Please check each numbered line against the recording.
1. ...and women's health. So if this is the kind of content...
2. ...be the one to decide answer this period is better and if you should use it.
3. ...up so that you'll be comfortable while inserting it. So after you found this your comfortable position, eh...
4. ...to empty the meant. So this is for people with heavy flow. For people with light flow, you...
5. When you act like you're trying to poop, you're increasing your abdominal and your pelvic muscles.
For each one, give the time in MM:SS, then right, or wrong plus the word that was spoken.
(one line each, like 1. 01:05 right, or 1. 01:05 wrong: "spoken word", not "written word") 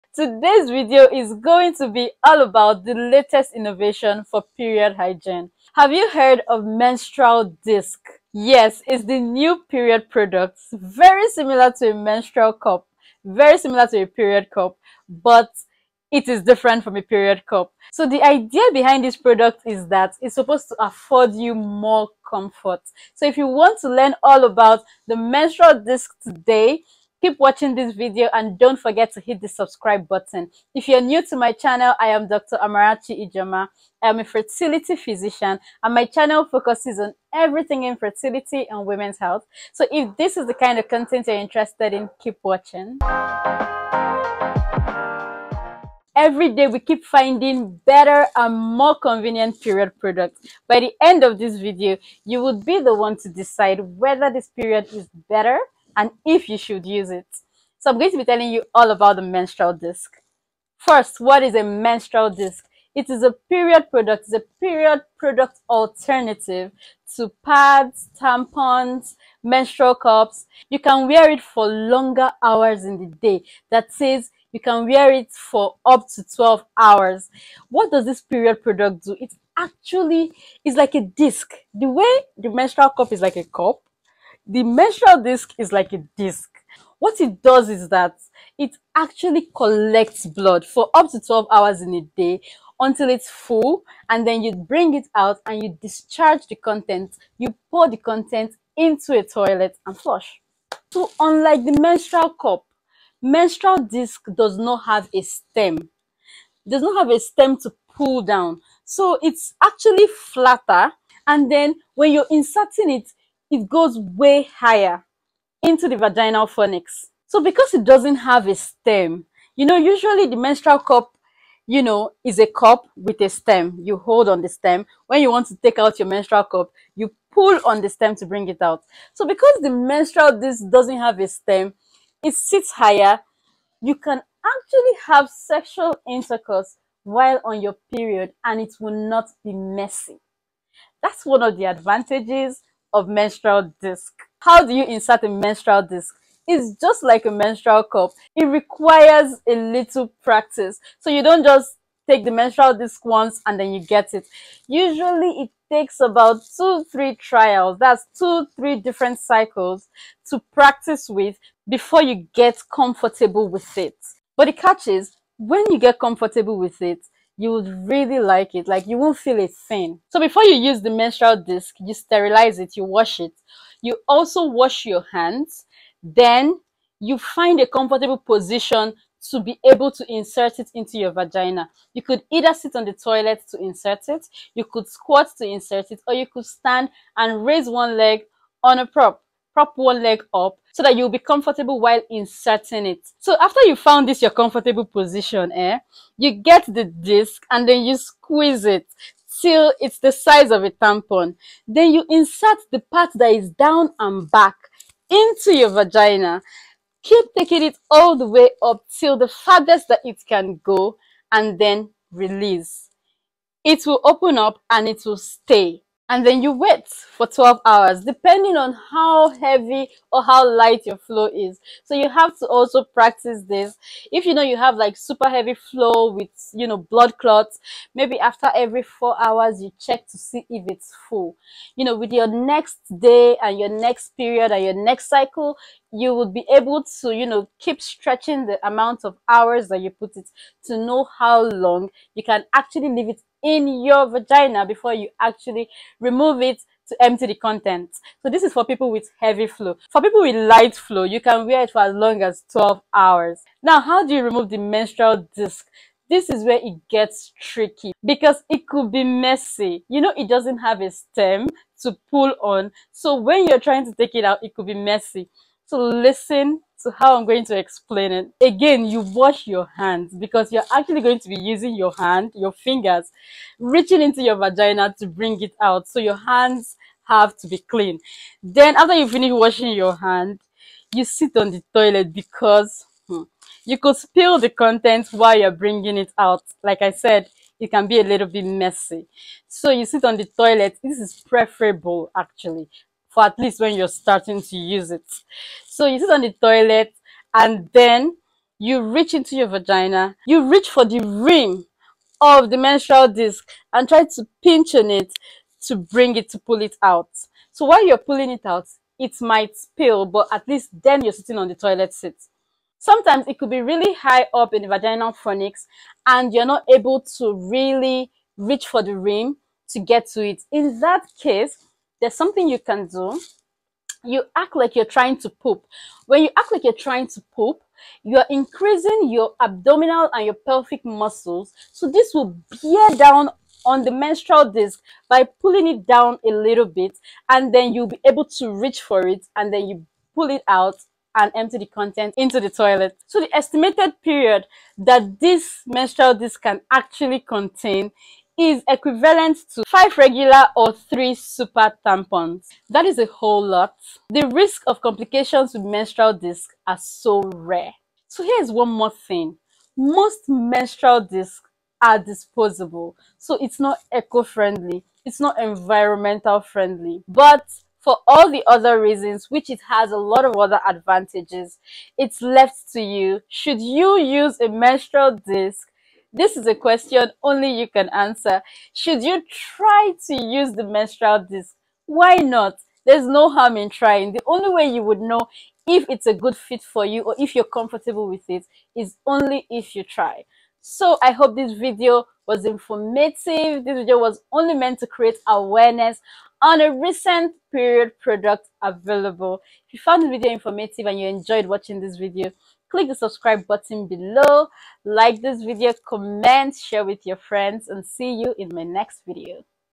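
1. 00:38 right
2. 00:52 wrong: "whether", not "answer"
3. 03:10 right
4. 04:06 wrong: "content", not "meant"
5. 05:26 right.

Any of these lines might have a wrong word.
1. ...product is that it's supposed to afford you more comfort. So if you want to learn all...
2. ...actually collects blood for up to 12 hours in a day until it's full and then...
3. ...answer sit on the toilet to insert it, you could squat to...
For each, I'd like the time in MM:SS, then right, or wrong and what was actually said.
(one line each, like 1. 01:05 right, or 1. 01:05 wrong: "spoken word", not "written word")
1. 00:19 right
2. 01:28 right
3. 03:02 wrong: "either", not "answer".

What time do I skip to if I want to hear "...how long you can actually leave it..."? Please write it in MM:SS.
04:01.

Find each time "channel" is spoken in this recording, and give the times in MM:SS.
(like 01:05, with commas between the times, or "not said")
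00:31, 00:36.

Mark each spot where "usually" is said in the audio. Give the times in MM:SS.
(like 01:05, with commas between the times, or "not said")
01:59, 02:34.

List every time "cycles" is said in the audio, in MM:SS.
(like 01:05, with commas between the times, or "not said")
02:39, 03:55.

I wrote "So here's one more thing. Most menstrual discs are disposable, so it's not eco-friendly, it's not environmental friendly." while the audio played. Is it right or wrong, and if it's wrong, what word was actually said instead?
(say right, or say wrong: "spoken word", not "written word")
right.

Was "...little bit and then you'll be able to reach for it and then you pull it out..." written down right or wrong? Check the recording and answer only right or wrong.
right.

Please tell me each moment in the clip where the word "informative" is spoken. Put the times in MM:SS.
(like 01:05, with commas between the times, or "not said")
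06:32, 06:40.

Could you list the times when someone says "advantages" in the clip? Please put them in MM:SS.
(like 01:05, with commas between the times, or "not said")
02:21, 06:10.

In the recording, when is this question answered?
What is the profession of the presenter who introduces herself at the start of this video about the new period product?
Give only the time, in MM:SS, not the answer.
00:34.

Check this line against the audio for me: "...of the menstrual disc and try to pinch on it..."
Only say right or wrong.
right.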